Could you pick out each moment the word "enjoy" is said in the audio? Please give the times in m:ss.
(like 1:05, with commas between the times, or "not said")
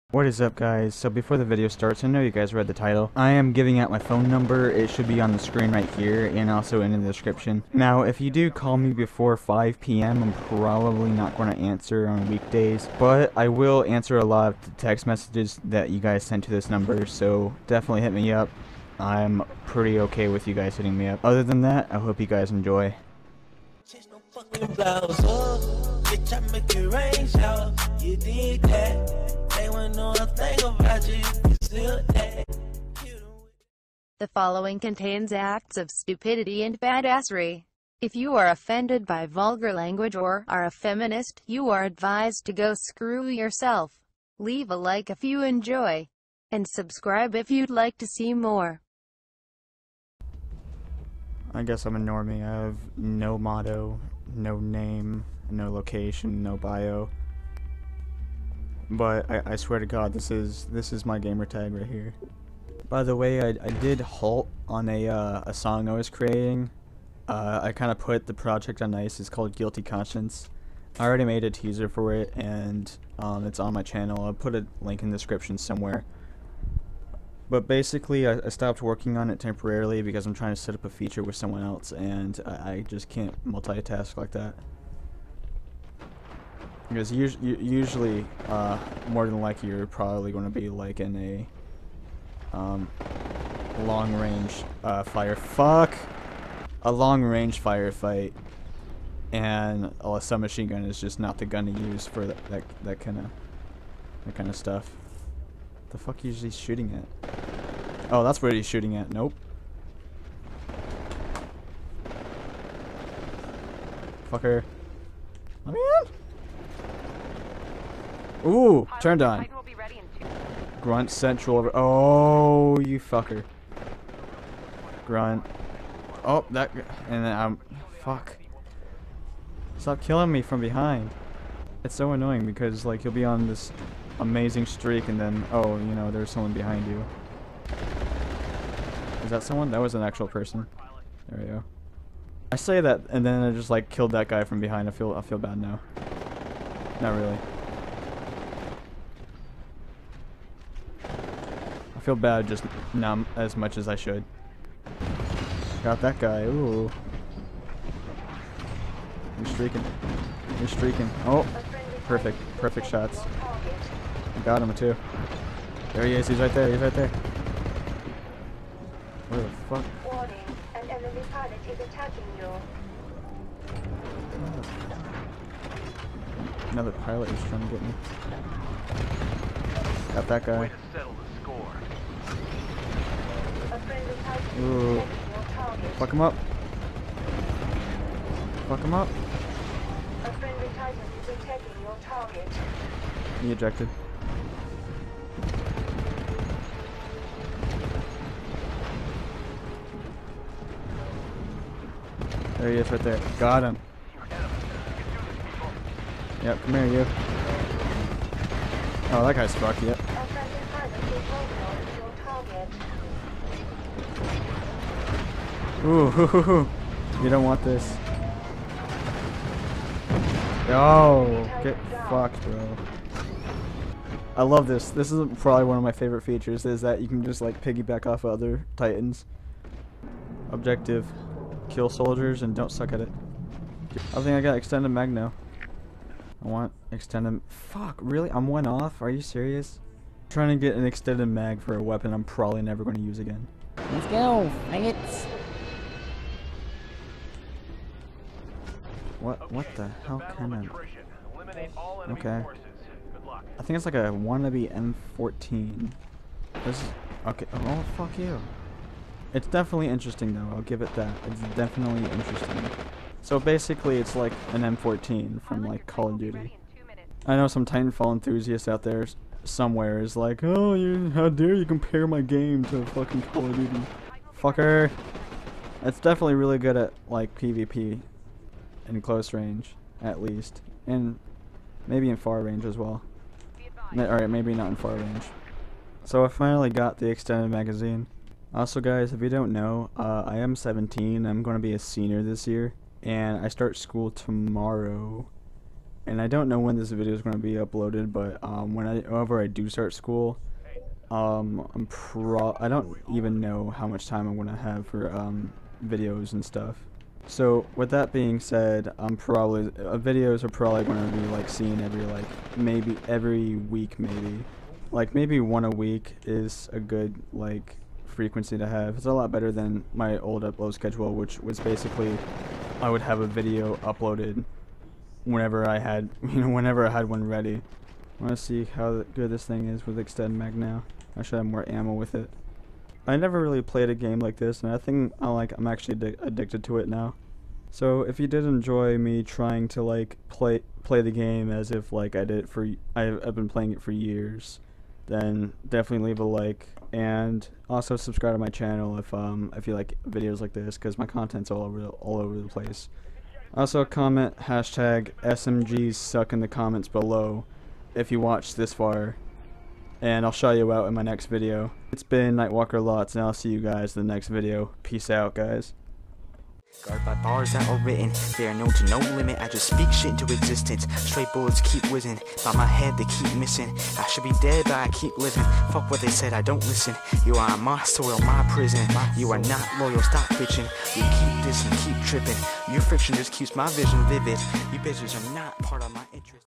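0:22, 0:45, 5:38.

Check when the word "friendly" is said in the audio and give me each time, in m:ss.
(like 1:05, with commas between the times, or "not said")
3:10.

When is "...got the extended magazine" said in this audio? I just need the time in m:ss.
4:46.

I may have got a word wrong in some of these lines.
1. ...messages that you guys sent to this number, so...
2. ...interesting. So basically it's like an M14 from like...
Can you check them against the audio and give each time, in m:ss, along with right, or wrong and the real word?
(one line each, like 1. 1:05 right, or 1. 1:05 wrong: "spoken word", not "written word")
1. 0:15 right
2. 4:22 right.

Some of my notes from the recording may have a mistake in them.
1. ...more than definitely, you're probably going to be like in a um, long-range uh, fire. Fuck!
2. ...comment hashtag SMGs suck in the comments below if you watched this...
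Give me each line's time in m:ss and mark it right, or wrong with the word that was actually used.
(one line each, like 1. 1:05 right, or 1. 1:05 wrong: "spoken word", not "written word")
1. 1:29 wrong: "likely", not "definitely"
2. 5:53 right.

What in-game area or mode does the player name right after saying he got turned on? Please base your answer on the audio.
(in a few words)
Grunt Central.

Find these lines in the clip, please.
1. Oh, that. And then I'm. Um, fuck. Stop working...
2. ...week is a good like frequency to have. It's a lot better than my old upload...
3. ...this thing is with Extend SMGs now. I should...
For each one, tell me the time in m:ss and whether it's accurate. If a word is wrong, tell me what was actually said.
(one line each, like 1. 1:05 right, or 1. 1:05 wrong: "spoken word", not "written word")
1. 2:06 wrong: "killing", not "working"
2. 5:15 right
3. 5:29 wrong: "Mag", not "SMGs".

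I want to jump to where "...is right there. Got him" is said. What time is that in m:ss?
3:22.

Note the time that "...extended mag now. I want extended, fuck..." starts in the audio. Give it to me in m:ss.
3:54.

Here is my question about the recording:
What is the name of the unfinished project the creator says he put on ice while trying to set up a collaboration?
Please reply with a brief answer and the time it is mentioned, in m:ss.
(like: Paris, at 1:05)
Guilty Conscience, at 1:09.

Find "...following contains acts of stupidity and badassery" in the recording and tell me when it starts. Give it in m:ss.
0:34.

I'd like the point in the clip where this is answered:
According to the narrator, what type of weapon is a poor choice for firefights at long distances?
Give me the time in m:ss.
1:40.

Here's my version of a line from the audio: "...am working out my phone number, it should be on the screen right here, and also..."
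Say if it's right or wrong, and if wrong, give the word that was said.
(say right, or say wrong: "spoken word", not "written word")
wrong: "giving", not "working".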